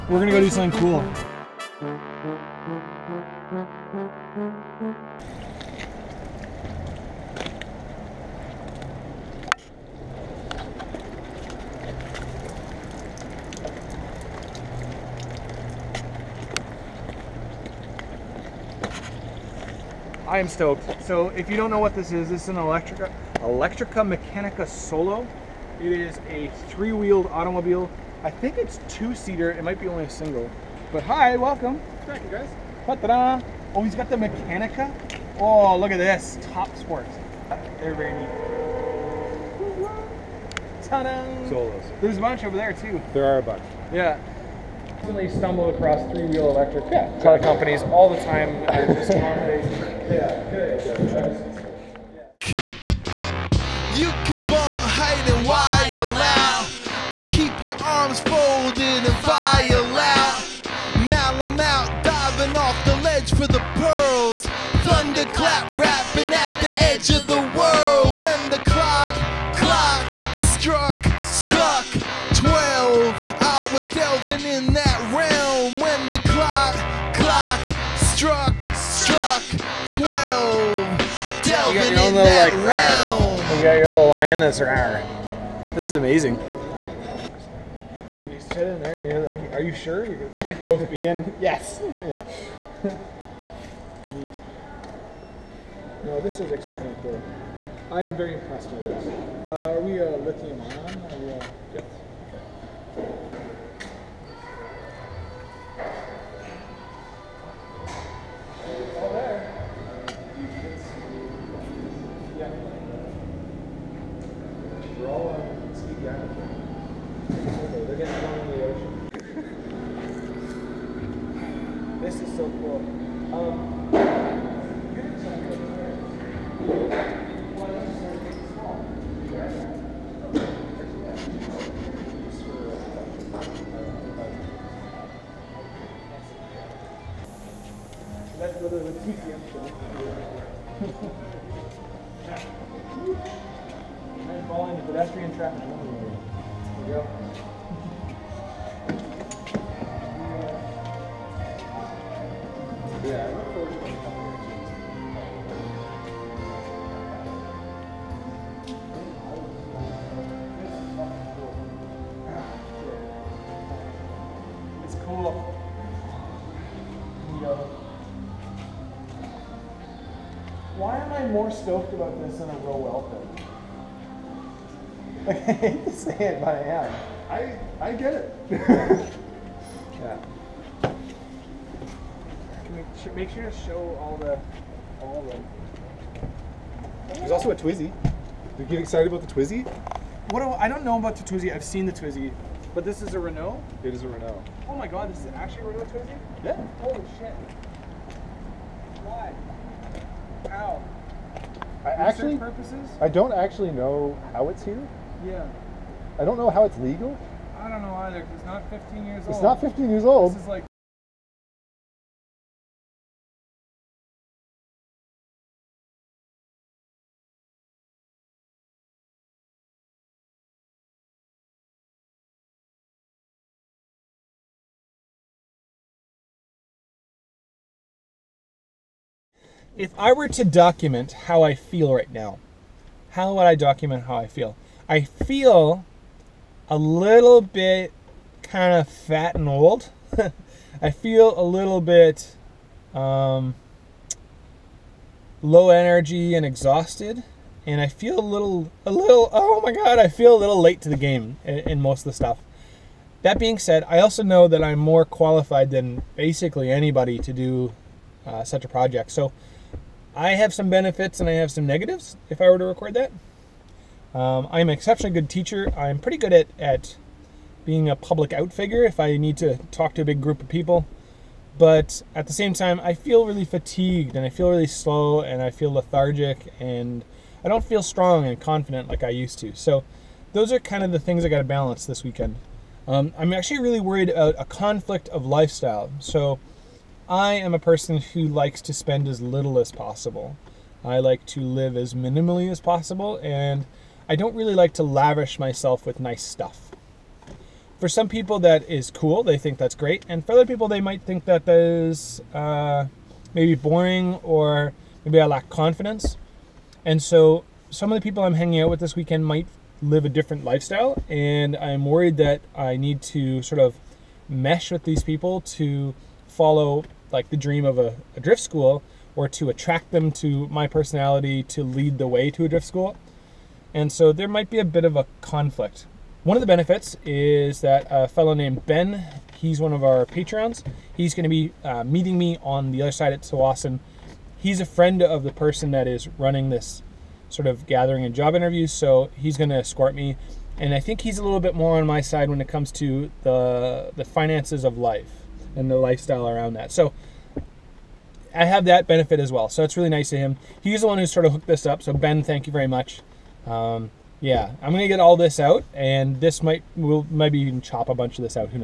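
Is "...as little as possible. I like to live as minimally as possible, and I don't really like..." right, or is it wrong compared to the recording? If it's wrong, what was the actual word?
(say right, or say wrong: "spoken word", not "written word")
right.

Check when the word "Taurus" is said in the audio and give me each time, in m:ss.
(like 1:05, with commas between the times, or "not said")
not said.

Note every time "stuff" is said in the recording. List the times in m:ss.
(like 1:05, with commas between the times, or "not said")
4:12, 4:56.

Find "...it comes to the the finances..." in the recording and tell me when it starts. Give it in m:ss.
5:42.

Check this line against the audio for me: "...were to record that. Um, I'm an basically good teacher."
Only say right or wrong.
wrong.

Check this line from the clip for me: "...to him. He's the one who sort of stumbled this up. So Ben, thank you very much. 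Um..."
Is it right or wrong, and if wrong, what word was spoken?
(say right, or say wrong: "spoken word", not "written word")
wrong: "hooked", not "stumbled".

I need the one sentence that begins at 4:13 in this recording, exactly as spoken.
That being said, I also know that I'm more qualified than basically anybody to do uh, such a project.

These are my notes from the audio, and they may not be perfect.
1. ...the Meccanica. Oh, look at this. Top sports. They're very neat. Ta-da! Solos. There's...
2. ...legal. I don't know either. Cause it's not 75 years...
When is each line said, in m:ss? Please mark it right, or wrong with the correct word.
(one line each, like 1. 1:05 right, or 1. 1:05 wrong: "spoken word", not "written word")
1. 0:34 right
2. 3:26 wrong: "15", not "75".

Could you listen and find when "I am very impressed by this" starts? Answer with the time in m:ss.
1:37.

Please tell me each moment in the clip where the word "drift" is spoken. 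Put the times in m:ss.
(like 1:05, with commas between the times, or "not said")
5:18, 5:22.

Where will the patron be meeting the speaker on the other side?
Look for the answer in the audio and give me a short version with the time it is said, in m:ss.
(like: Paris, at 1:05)
Tsawwassen, at 5:33.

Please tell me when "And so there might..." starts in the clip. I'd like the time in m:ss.
5:23.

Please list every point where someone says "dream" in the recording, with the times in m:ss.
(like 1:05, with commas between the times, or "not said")
5:17.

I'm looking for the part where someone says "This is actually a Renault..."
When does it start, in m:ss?
3:15.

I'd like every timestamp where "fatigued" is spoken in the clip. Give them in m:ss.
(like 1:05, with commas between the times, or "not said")
4:33.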